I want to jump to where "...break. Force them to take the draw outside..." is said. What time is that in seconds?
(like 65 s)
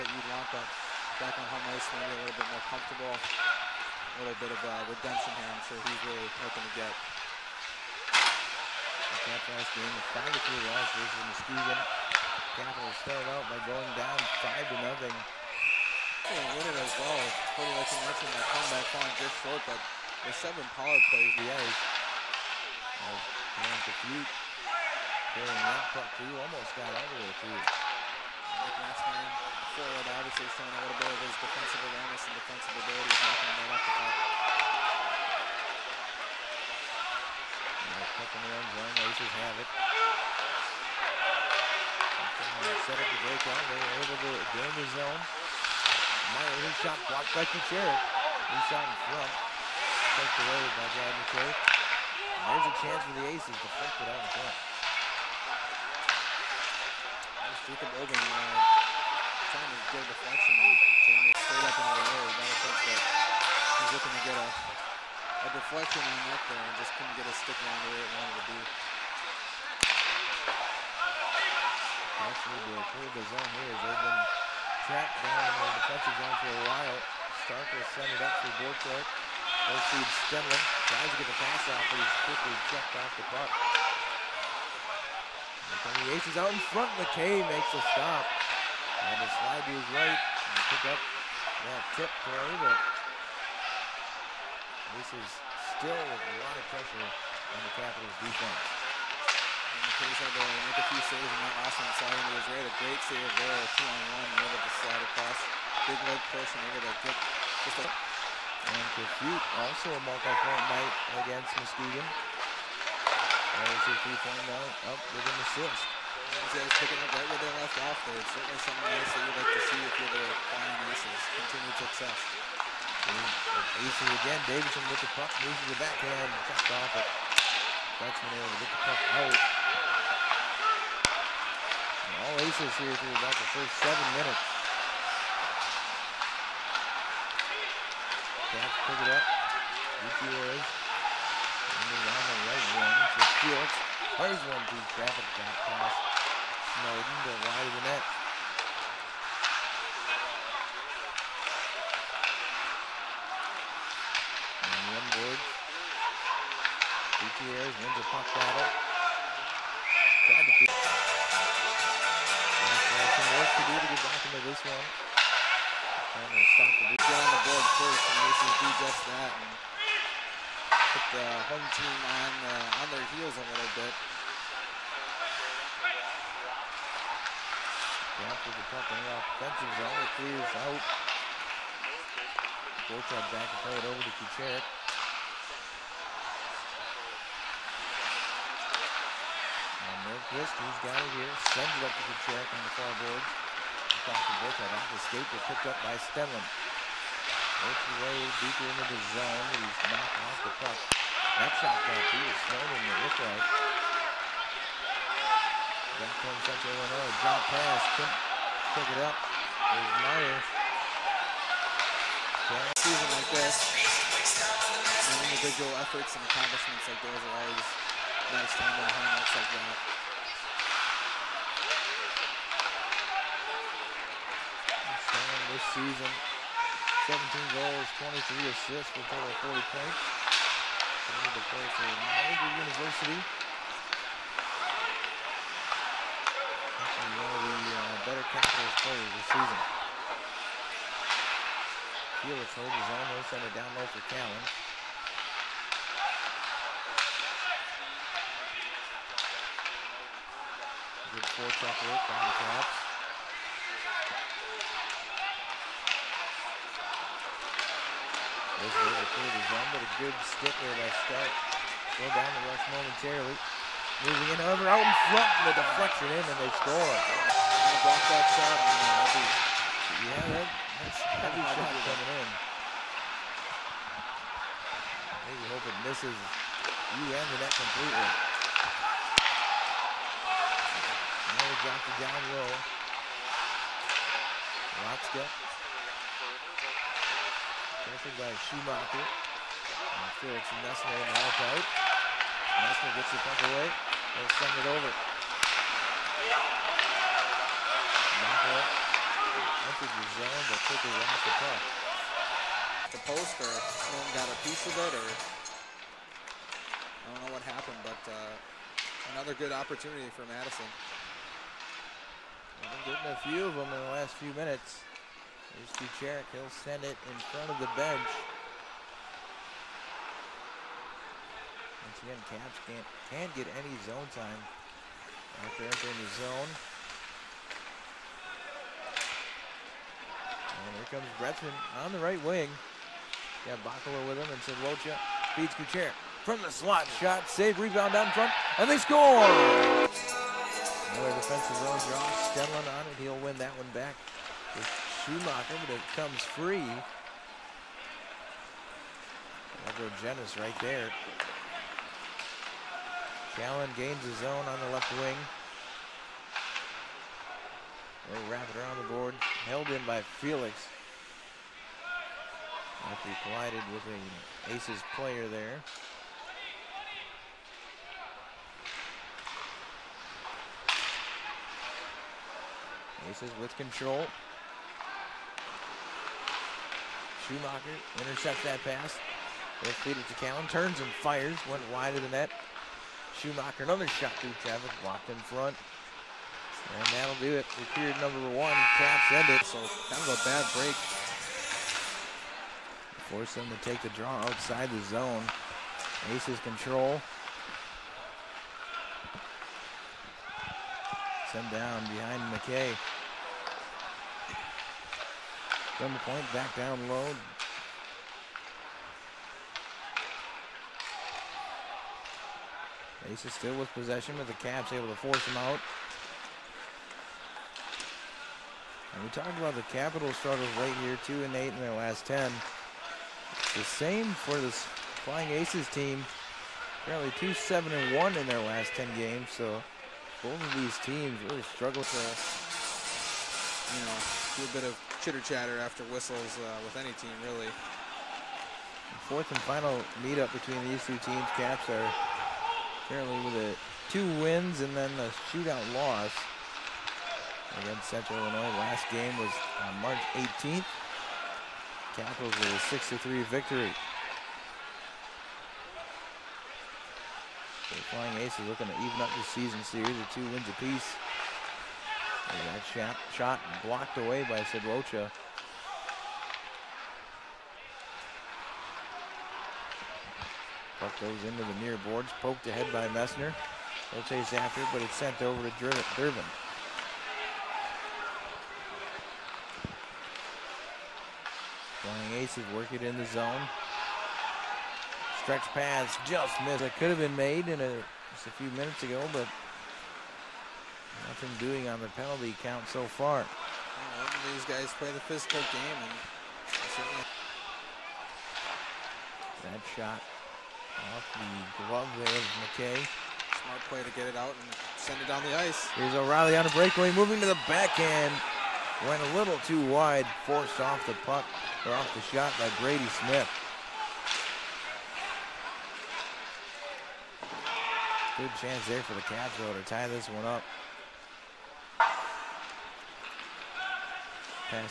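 390 s.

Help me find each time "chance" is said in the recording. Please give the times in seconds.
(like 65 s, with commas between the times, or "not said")
52 s, 518 s.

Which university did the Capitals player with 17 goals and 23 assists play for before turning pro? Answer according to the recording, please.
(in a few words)
Niagara University.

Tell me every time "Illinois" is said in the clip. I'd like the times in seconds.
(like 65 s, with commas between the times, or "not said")
206 s, 448 s.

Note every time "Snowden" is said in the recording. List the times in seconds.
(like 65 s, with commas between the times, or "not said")
146 s.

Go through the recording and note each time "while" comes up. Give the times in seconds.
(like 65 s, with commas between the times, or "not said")
76 s.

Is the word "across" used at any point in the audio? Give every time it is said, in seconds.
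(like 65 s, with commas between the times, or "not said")
105 s, 193 s.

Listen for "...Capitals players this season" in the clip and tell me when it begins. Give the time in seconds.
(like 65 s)
238 s.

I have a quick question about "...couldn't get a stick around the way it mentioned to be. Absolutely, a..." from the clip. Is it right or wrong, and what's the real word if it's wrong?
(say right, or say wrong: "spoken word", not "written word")
wrong: "wanted", not "mentioned".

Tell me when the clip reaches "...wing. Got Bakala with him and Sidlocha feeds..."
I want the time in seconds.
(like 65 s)
332 s.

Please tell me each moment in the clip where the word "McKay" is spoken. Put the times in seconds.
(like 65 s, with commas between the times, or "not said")
87 s, 402 s, 502 s.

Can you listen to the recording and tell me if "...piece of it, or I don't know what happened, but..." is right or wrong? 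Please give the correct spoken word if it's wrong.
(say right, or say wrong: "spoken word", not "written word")
right.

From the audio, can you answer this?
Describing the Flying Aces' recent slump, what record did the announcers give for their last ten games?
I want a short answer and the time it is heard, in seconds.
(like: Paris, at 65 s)
2-7-1, at 427 s.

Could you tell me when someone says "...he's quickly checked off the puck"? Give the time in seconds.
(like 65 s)
81 s.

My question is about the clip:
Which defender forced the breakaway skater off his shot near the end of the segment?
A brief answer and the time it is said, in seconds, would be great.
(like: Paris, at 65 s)
Brady Smith, at 512 s.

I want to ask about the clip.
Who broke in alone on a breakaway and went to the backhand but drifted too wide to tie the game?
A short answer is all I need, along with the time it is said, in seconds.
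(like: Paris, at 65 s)
O'Reilly, at 505 s.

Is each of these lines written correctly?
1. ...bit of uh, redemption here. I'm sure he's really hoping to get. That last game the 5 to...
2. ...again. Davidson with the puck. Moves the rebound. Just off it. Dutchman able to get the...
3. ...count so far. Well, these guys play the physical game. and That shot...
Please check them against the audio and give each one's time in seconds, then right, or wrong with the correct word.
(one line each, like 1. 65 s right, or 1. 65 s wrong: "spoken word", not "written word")
1. 4 s right
2. 124 s wrong: "backhand", not "rebound"
3. 492 s right.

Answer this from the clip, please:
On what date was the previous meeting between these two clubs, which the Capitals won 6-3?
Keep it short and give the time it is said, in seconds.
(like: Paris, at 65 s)
March 18, at 449 s.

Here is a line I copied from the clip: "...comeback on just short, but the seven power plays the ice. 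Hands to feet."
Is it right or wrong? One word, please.
right.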